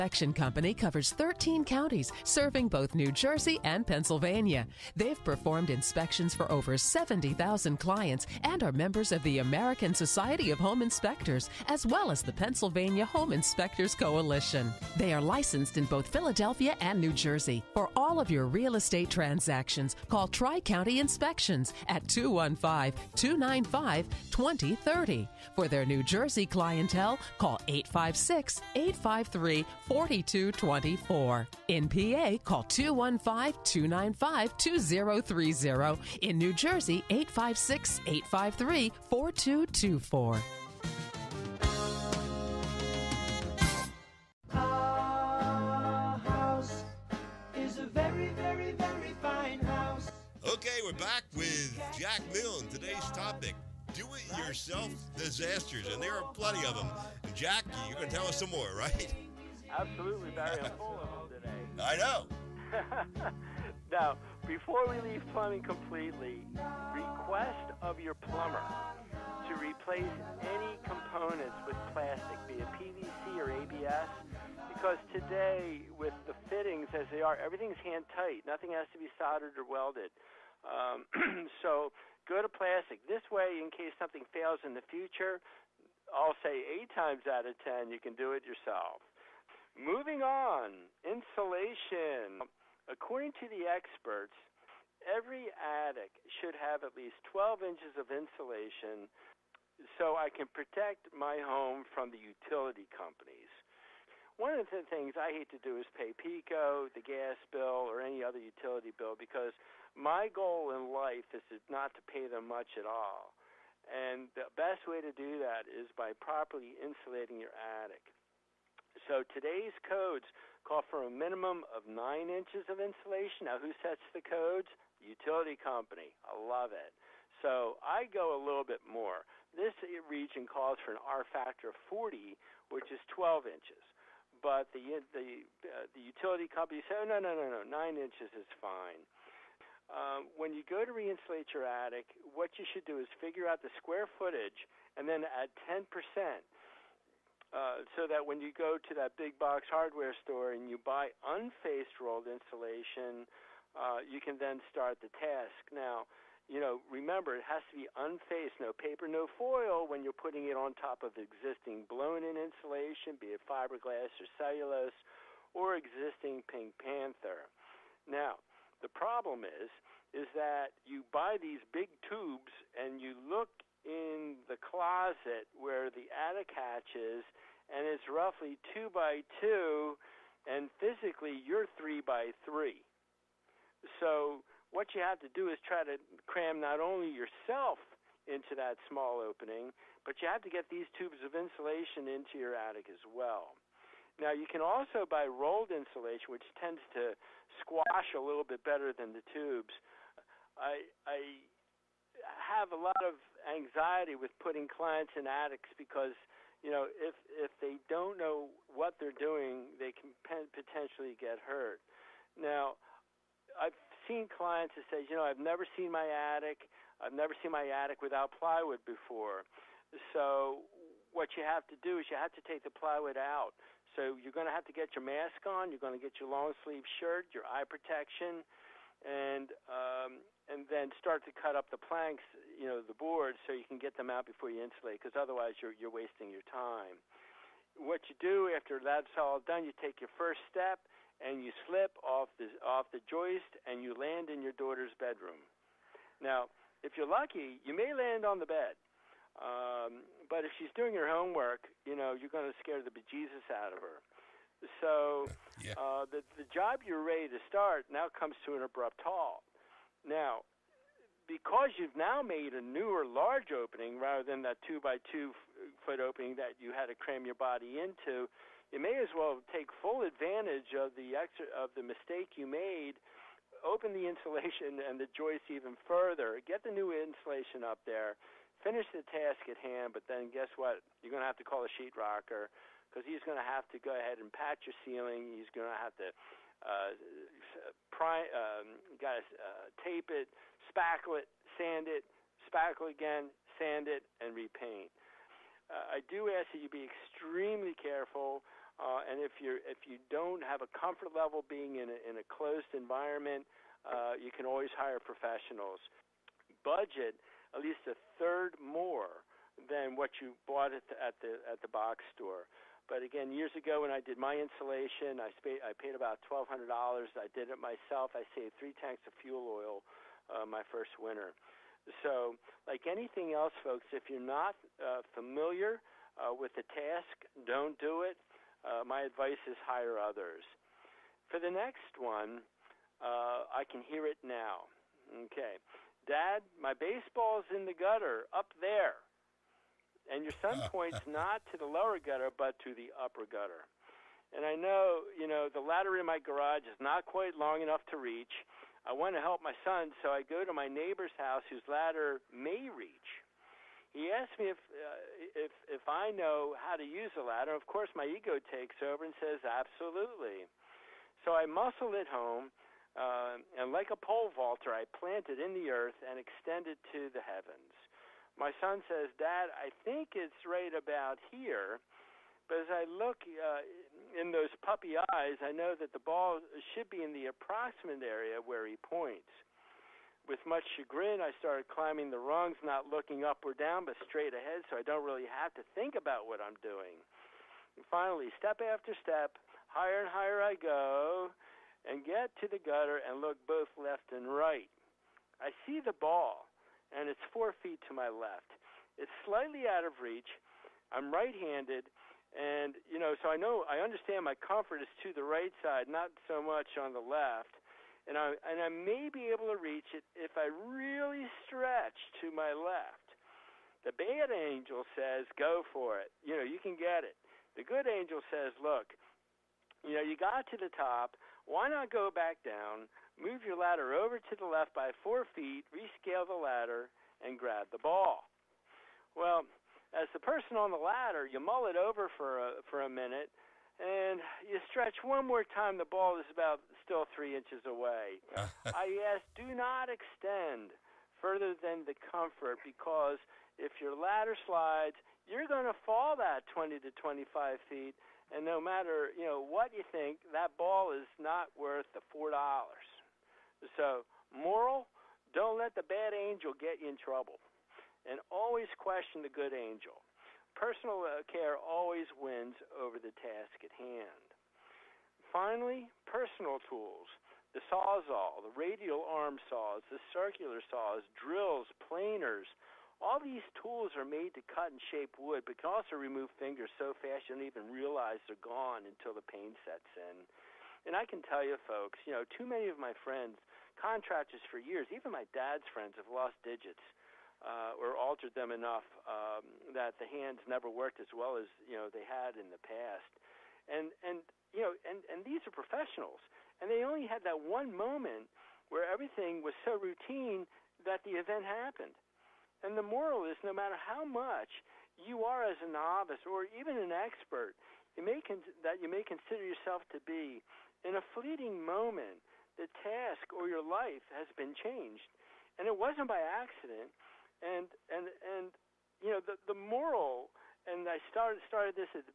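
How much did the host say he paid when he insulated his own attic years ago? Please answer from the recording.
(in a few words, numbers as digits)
$1,200.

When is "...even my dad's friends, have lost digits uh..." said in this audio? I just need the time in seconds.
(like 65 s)
484 s.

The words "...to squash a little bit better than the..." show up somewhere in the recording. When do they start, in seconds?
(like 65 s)
196 s.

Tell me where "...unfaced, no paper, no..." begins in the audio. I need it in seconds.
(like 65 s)
157 s.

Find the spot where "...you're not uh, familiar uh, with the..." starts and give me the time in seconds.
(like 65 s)
324 s.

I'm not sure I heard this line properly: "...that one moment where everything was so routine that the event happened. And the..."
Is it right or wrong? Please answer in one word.
right.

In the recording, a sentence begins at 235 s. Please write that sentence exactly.
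Because otherwise, you're you're wasting your time.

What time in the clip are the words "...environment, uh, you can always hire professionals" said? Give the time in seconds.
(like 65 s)
302 s.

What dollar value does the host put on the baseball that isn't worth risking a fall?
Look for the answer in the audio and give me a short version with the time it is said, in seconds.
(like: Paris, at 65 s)
$4, at 452 s.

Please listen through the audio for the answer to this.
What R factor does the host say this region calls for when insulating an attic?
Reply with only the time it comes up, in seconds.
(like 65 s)
131 s.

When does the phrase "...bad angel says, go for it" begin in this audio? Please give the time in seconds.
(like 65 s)
413 s.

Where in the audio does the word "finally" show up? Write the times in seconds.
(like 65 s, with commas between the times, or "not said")
387 s, 465 s.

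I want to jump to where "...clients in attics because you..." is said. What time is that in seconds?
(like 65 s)
204 s.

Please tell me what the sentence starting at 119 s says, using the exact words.
So today's codes call for a minimum of nine inches of insulation.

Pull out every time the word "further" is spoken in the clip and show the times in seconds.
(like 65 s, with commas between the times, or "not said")
275 s, 441 s.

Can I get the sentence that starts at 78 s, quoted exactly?
Nothing has to be soldered or welded.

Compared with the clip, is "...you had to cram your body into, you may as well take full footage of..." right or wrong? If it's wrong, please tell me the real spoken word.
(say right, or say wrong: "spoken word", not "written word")
wrong: "advantage", not "footage".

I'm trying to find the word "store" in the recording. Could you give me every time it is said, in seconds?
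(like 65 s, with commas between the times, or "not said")
150 s, 312 s.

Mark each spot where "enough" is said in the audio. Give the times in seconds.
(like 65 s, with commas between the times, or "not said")
347 s, 488 s.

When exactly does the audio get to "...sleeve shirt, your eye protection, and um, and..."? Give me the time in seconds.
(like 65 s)
226 s.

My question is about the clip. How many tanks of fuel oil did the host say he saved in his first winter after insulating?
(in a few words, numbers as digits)
3.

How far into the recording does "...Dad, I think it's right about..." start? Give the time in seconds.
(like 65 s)
369 s.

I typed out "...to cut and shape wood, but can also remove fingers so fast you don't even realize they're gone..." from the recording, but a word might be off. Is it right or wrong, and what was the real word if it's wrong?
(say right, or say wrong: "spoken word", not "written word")
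right.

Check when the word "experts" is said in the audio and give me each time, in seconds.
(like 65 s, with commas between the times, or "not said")
93 s, 506 s.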